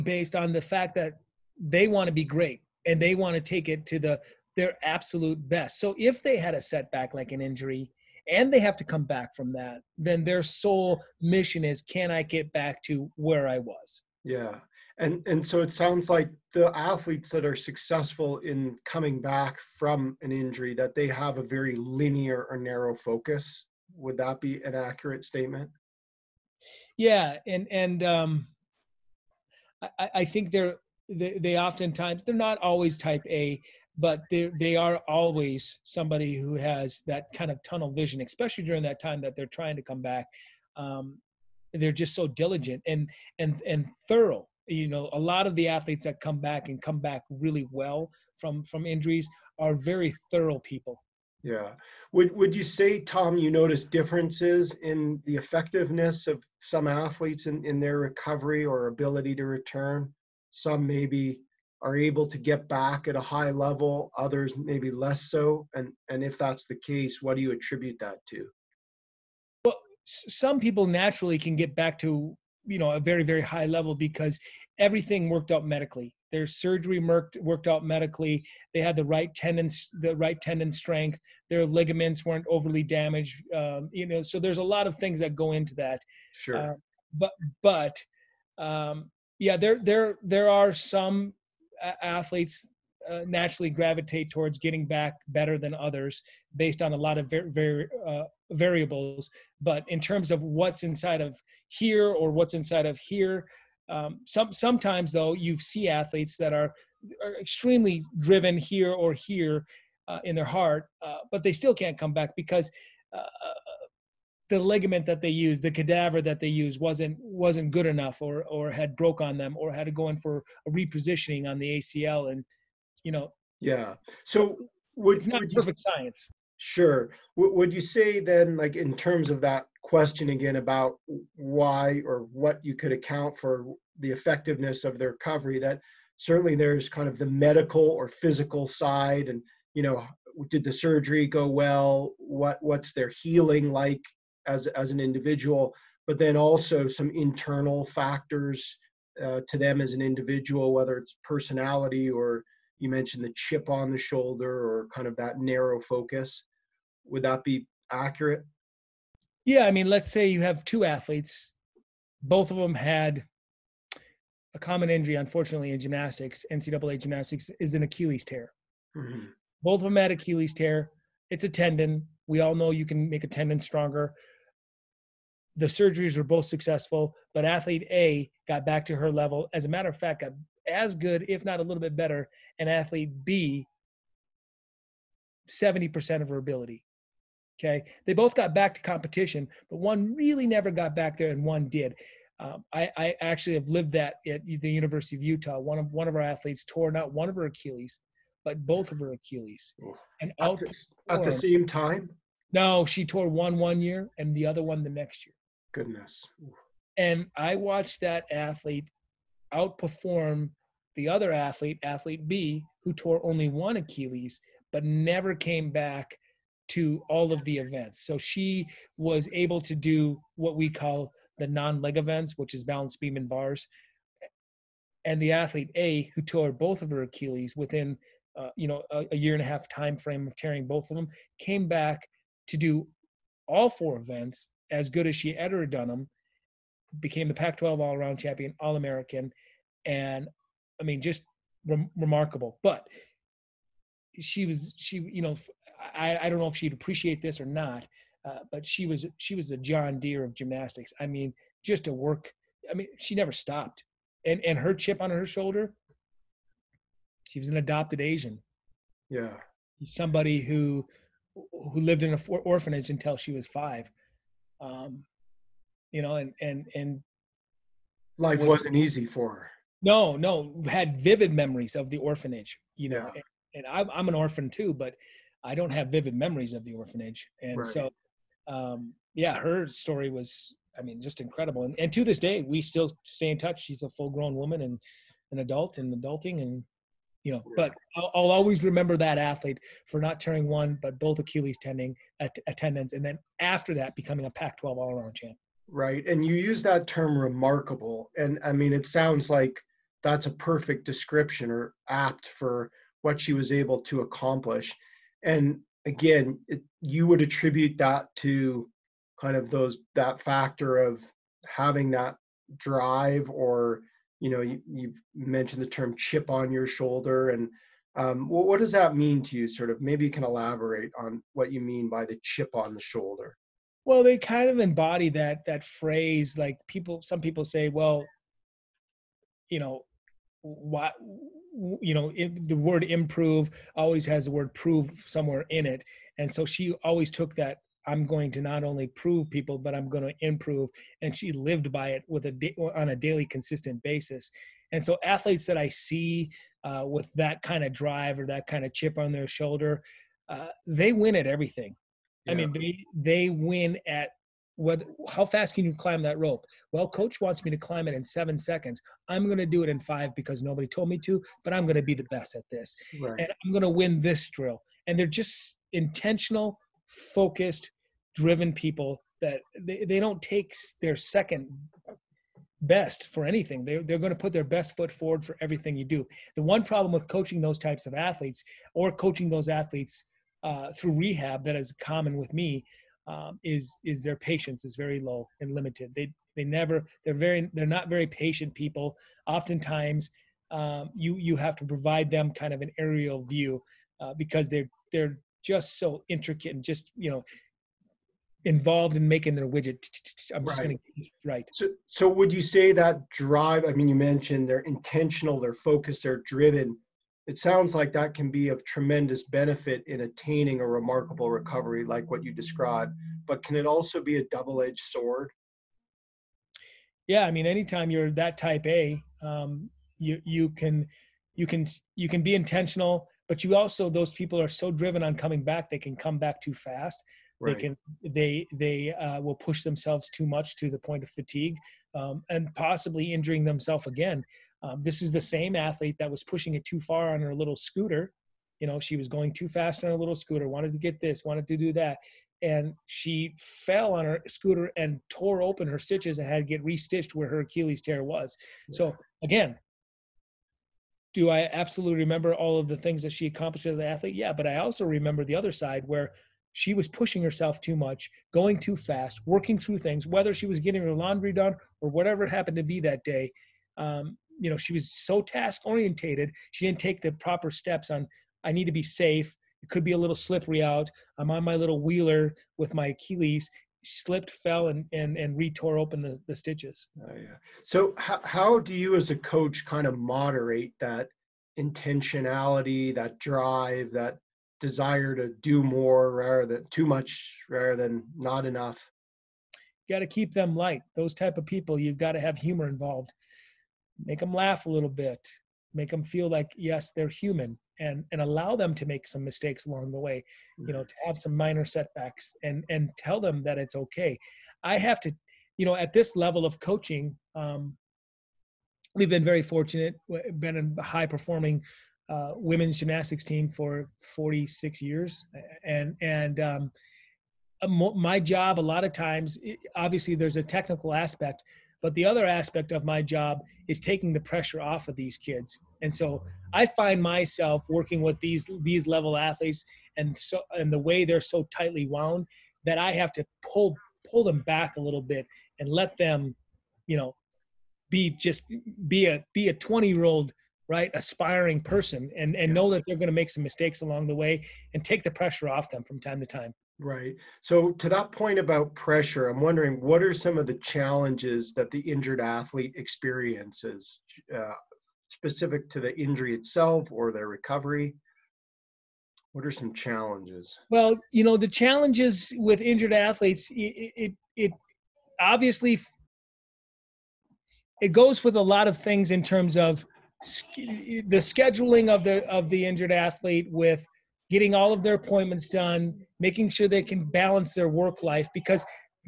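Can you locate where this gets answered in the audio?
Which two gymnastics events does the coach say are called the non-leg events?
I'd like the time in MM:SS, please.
03:42.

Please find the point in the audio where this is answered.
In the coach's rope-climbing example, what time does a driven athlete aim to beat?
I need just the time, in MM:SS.
05:58.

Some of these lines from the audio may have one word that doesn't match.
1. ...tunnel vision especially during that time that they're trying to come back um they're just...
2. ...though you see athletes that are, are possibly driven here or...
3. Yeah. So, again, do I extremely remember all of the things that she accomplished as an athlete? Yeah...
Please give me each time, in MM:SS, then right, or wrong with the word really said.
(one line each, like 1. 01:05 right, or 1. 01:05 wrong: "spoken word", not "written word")
1. 00:37 right
2. 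01:45 wrong: "extremely", not "possibly"
3. 07:28 wrong: "absolutely", not "extremely".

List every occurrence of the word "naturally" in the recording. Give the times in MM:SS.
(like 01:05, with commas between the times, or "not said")
01:10, 01:33.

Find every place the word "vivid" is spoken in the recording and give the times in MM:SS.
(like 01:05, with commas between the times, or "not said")
04:30, 04:35.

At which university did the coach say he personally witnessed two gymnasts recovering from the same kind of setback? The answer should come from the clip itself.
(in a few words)
University of Utah.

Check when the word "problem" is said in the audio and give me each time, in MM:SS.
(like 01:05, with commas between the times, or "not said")
06:16.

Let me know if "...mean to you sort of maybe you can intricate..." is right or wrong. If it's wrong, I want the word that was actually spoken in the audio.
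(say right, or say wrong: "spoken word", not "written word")
wrong: "elaborate", not "intricate".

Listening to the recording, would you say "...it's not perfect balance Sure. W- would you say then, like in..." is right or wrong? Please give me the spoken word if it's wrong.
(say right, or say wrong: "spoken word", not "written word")
wrong: "science", not "balance".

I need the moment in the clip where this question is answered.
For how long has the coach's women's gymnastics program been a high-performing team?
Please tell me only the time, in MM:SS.
08:34.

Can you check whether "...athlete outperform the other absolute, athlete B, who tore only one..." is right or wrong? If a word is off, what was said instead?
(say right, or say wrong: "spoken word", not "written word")
wrong: "athlete", not "absolute".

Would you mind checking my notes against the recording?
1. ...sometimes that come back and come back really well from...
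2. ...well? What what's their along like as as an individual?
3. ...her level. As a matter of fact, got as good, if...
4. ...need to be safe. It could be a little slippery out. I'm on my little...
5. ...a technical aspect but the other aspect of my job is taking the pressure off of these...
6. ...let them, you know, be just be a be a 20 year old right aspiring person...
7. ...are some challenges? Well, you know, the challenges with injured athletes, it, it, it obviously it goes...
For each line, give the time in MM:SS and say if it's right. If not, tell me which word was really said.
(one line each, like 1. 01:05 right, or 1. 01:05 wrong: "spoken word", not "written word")
1. 00:45 wrong: "athletes", not "sometimes"
2. 02:21 wrong: "healing", not "along"
3. 02:58 right
4. 07:48 right
5. 08:40 right
6. 08:55 right
7. 09:19 right.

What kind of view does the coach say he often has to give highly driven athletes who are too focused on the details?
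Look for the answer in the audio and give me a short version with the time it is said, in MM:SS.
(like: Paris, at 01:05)
An aerial view, at 06:32.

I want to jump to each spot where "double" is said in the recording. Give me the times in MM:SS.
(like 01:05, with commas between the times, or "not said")
06:54.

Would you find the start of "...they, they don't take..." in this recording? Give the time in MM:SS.
06:09.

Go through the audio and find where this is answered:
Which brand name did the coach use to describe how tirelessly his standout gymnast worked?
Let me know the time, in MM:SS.
04:09.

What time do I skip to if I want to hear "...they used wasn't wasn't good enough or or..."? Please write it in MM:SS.
01:56.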